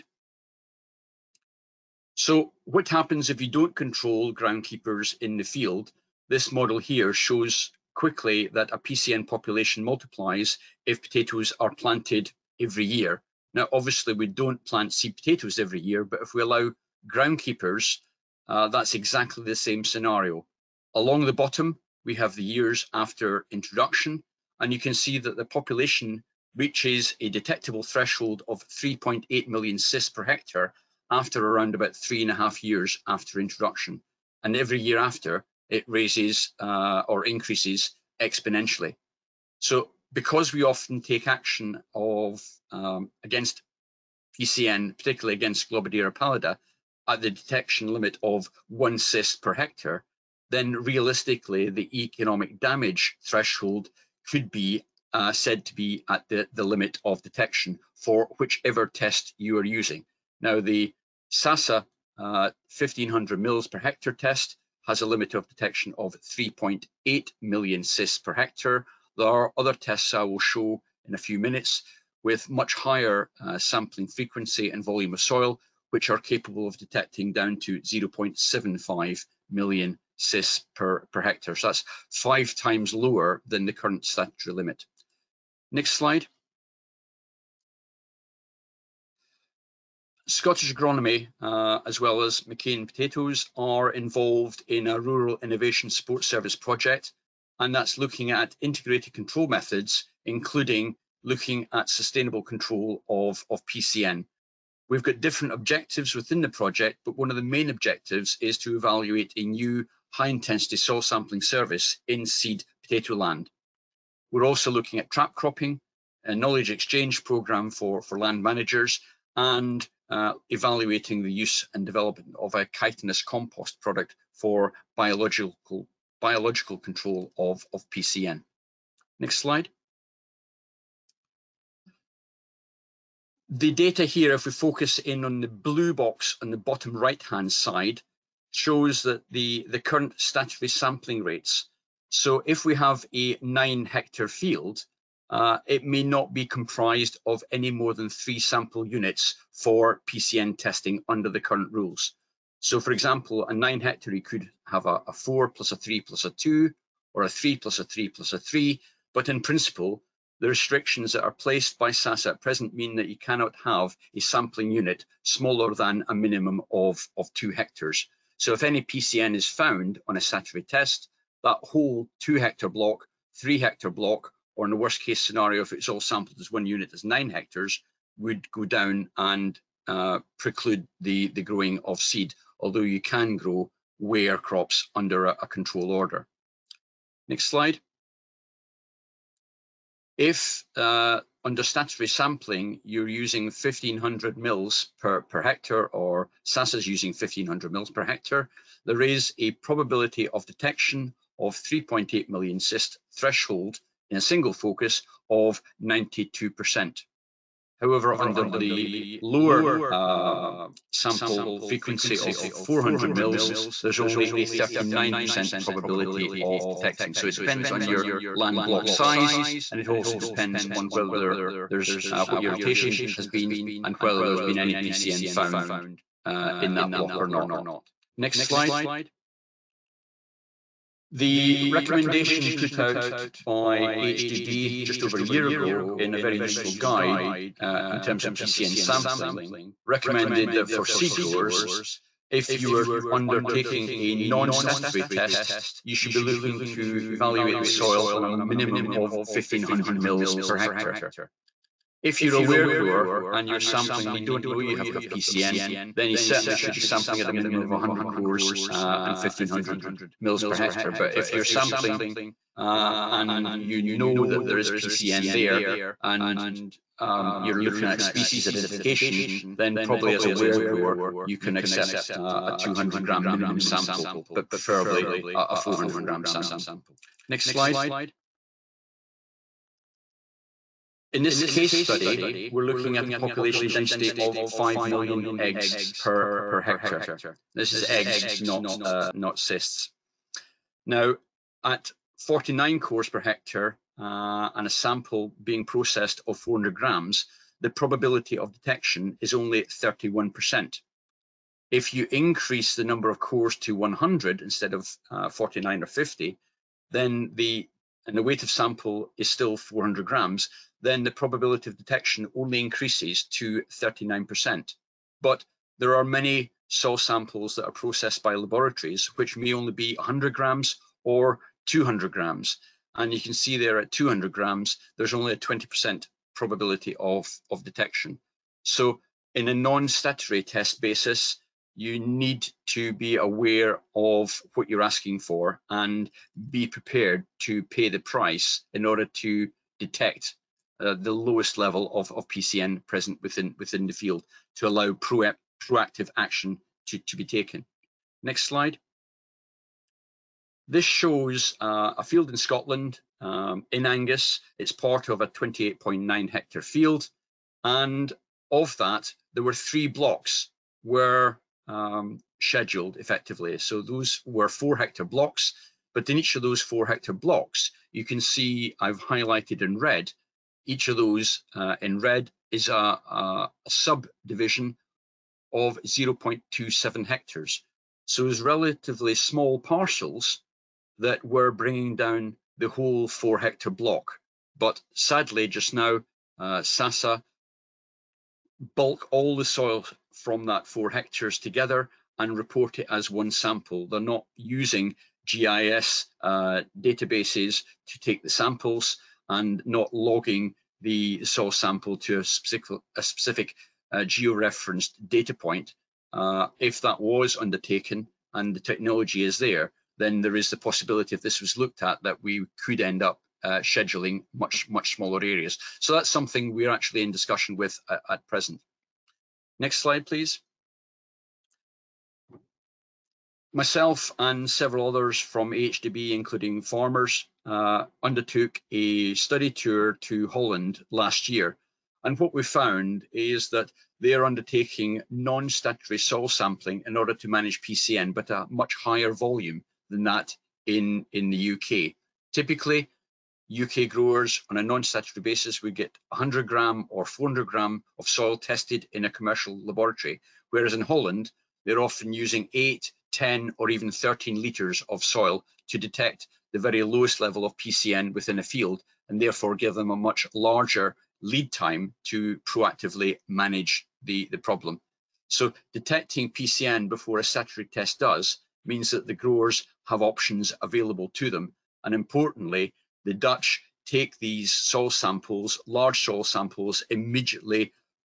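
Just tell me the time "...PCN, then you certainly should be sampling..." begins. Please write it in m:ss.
4:15.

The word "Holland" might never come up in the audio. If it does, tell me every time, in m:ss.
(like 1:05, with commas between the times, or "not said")
7:10, 7:30.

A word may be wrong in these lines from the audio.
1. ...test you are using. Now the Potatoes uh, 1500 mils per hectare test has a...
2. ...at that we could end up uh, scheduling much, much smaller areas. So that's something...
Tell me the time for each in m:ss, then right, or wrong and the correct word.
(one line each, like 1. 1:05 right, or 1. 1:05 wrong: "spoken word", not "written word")
1. 0:58 wrong: "SASA", not "Potatoes"
2. 6:51 right.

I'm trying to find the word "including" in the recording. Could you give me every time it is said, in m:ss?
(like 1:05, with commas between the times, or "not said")
1:40, 7:06.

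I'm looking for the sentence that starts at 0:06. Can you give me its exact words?
This model here shows quickly that a PCN population multiplies if potatoes are planted every year.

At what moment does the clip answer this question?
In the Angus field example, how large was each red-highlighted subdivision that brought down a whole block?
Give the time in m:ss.
6:15.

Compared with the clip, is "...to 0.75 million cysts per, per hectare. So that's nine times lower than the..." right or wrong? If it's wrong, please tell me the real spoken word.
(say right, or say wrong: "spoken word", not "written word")
wrong: "five", not "nine".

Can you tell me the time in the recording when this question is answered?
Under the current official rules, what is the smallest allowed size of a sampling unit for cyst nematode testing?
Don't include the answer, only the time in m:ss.
2:47.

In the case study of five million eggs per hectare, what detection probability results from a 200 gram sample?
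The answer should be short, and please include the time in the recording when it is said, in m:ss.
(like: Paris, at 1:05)
20%, at 5:25.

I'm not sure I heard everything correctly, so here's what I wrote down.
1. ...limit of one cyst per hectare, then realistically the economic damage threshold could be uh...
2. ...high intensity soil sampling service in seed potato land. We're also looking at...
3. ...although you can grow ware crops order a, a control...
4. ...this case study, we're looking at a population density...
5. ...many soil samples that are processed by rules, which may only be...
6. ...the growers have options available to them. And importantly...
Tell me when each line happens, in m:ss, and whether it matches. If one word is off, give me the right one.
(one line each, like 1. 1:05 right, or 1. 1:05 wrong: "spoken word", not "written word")
1. 0:47 right
2. 1:50 right
3. 3:02 wrong: "under", not "order"
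4. 4:41 right
5. 5:16 wrong: "laboratories", not "rules"
6. 7:49 right.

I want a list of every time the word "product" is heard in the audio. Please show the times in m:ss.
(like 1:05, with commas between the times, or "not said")
2:03.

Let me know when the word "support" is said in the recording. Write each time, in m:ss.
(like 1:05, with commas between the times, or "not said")
1:35.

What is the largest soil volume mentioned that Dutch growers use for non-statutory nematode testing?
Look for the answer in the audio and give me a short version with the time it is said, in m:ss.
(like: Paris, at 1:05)
13 litres, at 7:33.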